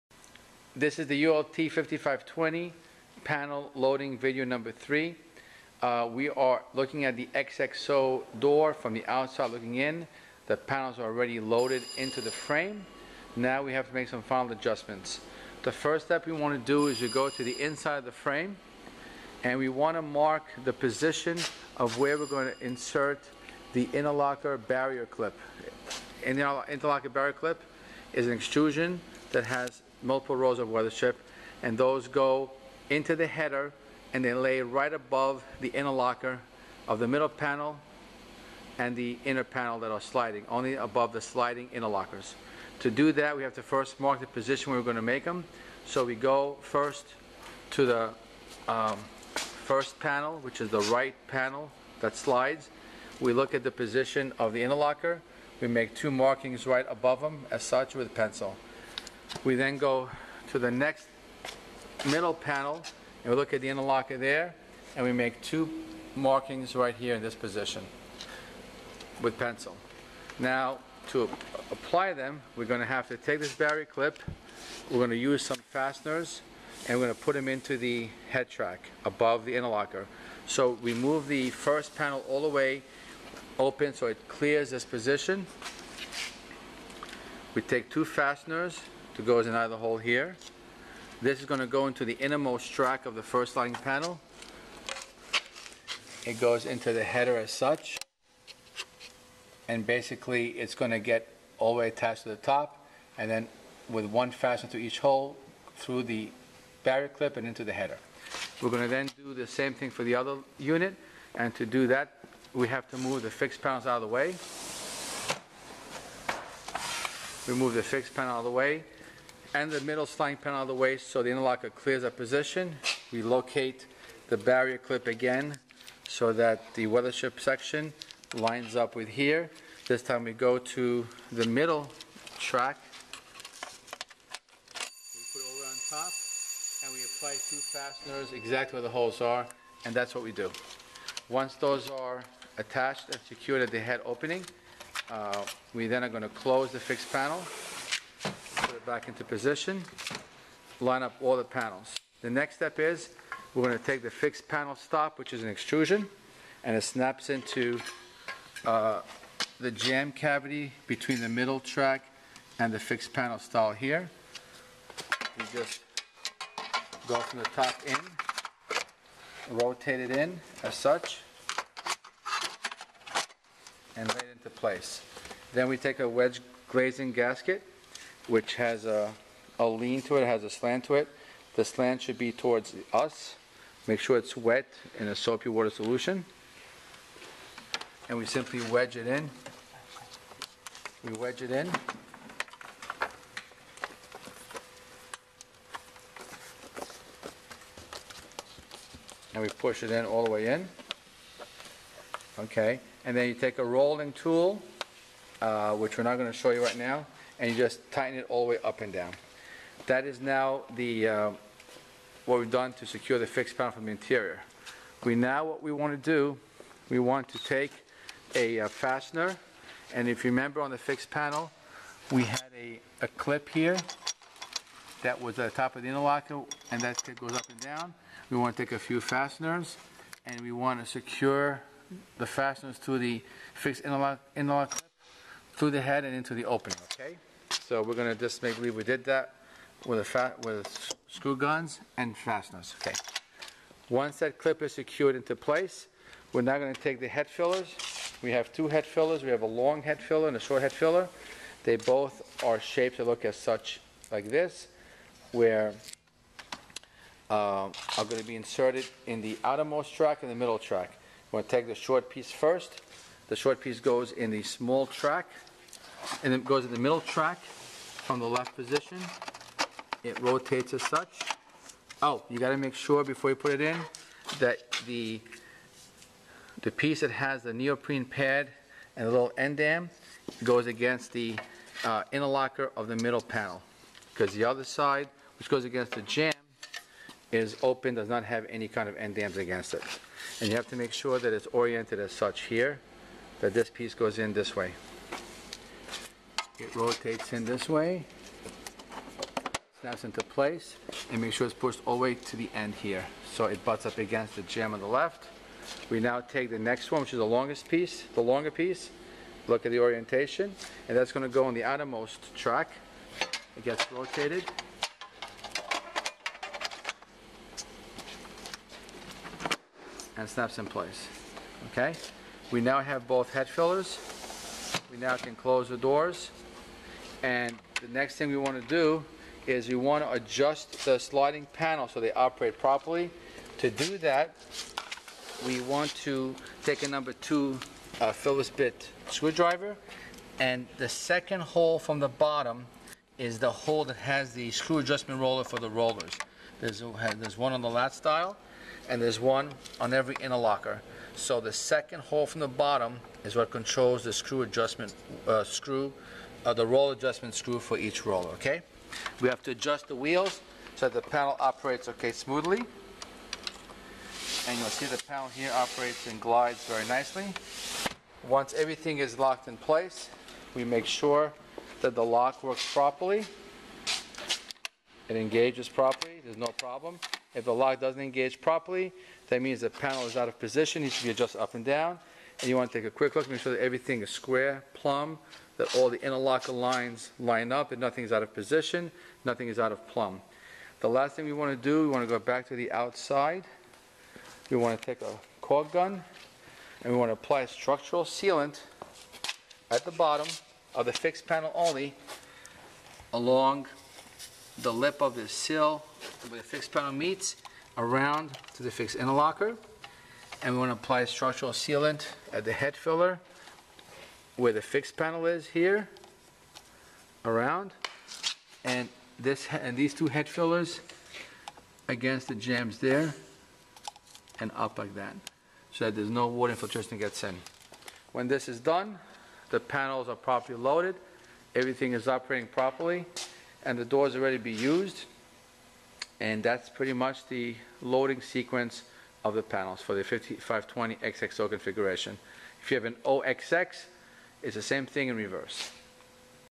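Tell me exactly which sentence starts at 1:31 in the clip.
This is going to go into the innermost track of the first lighting panel.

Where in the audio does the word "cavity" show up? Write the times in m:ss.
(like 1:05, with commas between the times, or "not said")
2:40.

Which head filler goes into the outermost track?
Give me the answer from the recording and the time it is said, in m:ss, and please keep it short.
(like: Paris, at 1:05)
The longer piece, at 5:08.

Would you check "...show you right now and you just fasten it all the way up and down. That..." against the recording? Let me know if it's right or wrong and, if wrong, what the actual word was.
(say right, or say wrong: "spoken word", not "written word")
wrong: "tighten", not "fasten".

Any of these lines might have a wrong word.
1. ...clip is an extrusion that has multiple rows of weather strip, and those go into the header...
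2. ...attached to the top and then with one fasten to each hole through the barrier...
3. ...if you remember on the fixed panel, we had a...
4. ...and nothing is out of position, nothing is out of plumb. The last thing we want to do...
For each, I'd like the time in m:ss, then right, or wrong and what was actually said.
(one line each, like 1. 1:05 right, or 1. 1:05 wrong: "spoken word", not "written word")
1. 0:27 right
2. 1:41 right
3. 3:40 right
4. 6:27 right.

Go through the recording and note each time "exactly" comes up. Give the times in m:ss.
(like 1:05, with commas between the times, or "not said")
2:18.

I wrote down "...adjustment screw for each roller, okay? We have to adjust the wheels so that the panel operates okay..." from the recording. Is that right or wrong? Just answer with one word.
right.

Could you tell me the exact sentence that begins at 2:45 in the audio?
You just go from the top in, rotate it in as such, and lay it into place.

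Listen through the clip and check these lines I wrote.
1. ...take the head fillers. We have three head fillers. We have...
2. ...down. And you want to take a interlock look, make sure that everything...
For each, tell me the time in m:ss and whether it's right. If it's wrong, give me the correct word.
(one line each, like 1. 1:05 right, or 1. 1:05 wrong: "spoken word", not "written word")
1. 4:06 wrong: "two", not "three"
2. 6:21 wrong: "quick", not "interlock".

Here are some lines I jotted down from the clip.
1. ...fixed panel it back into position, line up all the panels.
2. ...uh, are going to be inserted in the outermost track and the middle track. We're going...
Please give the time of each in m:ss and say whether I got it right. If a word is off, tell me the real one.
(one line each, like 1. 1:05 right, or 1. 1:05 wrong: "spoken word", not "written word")
1. 2:26 right
2. 4:17 right.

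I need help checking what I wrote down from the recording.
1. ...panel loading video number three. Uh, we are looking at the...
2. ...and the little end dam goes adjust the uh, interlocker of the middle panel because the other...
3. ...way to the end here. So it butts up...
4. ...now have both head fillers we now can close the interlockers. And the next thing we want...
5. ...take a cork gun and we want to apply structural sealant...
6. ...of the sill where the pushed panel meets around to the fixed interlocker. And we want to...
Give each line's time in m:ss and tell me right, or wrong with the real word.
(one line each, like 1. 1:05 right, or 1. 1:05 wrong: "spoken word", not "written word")
1. 0:03 right
2. 4:38 wrong: "against", not "adjust"
3. 5:02 right
4. 5:22 wrong: "doors", not "interlockers"
5. 6:34 right
6. 6:45 wrong: "fixed", not "pushed".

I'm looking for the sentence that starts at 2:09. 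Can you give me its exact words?
This time we go to the middle track.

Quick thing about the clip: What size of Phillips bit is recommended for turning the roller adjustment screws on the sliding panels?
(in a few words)
Number 2.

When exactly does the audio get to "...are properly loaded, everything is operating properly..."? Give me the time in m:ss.
7:10.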